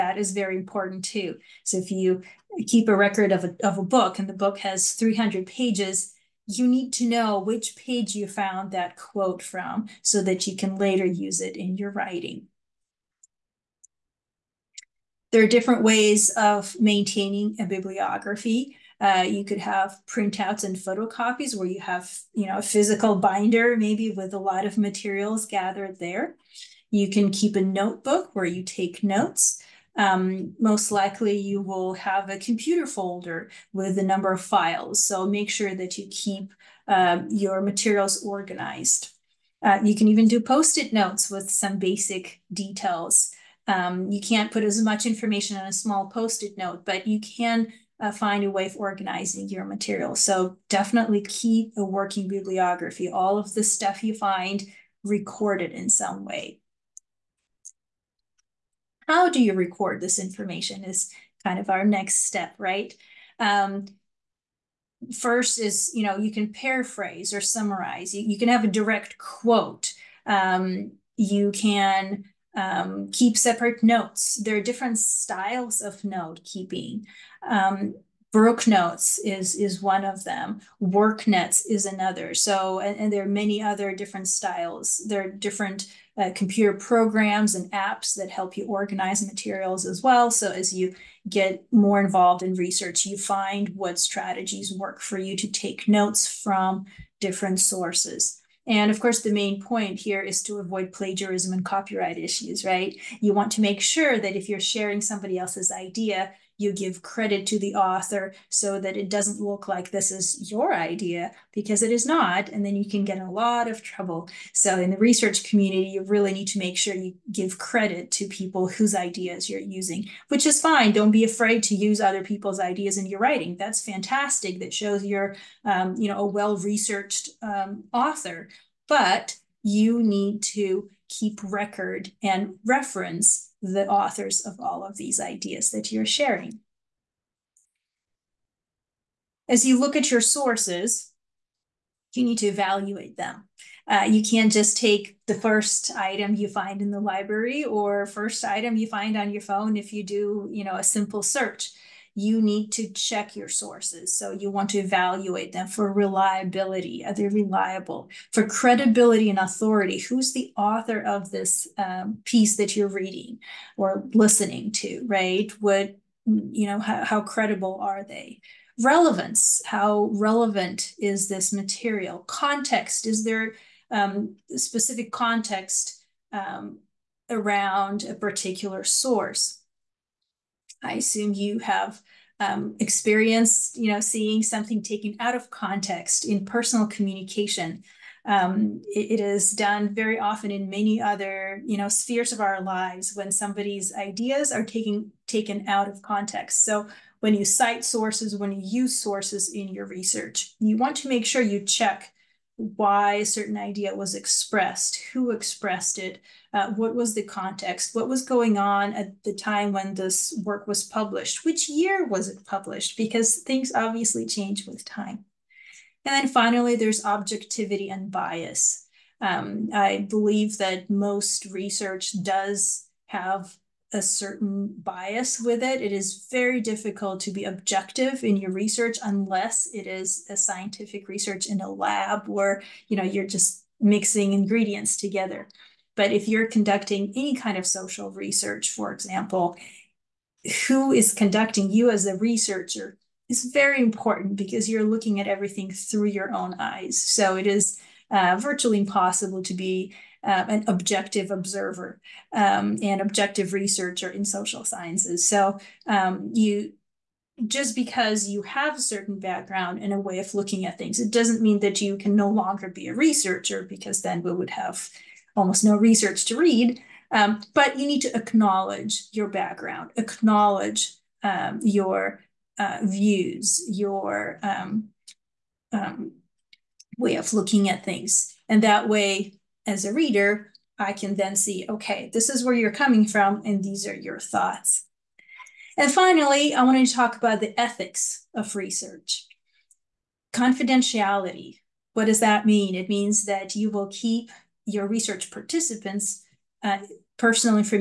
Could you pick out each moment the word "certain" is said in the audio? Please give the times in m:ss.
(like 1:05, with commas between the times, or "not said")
3:23, 3:44, 4:18.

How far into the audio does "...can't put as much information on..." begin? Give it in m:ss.
0:44.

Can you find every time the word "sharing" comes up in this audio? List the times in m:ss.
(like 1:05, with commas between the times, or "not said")
1:44, 2:16.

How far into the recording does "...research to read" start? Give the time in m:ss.
4:25.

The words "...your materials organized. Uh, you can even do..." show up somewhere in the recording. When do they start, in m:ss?
0:37.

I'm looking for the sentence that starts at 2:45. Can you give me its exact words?
What, you know, how, how credible are they?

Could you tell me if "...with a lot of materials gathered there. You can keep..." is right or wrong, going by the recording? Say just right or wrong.
right.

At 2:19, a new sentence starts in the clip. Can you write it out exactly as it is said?
As you look at your sources, you need to evaluate them.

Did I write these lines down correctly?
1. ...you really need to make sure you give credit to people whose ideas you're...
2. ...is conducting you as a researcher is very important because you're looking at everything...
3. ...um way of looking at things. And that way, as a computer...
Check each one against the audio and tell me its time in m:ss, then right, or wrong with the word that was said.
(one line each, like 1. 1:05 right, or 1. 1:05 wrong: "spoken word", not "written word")
1. 1:55 right
2. 4:00 right
3. 4:35 wrong: "reader", not "computer".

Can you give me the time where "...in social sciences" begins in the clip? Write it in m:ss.
4:14.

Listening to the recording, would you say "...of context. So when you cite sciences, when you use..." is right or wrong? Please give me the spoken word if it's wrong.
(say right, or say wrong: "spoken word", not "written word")
wrong: "sources", not "sciences".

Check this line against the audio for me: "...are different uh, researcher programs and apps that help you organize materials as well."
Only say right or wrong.
wrong.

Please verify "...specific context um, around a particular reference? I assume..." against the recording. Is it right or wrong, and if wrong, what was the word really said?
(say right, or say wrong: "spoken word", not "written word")
wrong: "source", not "reference".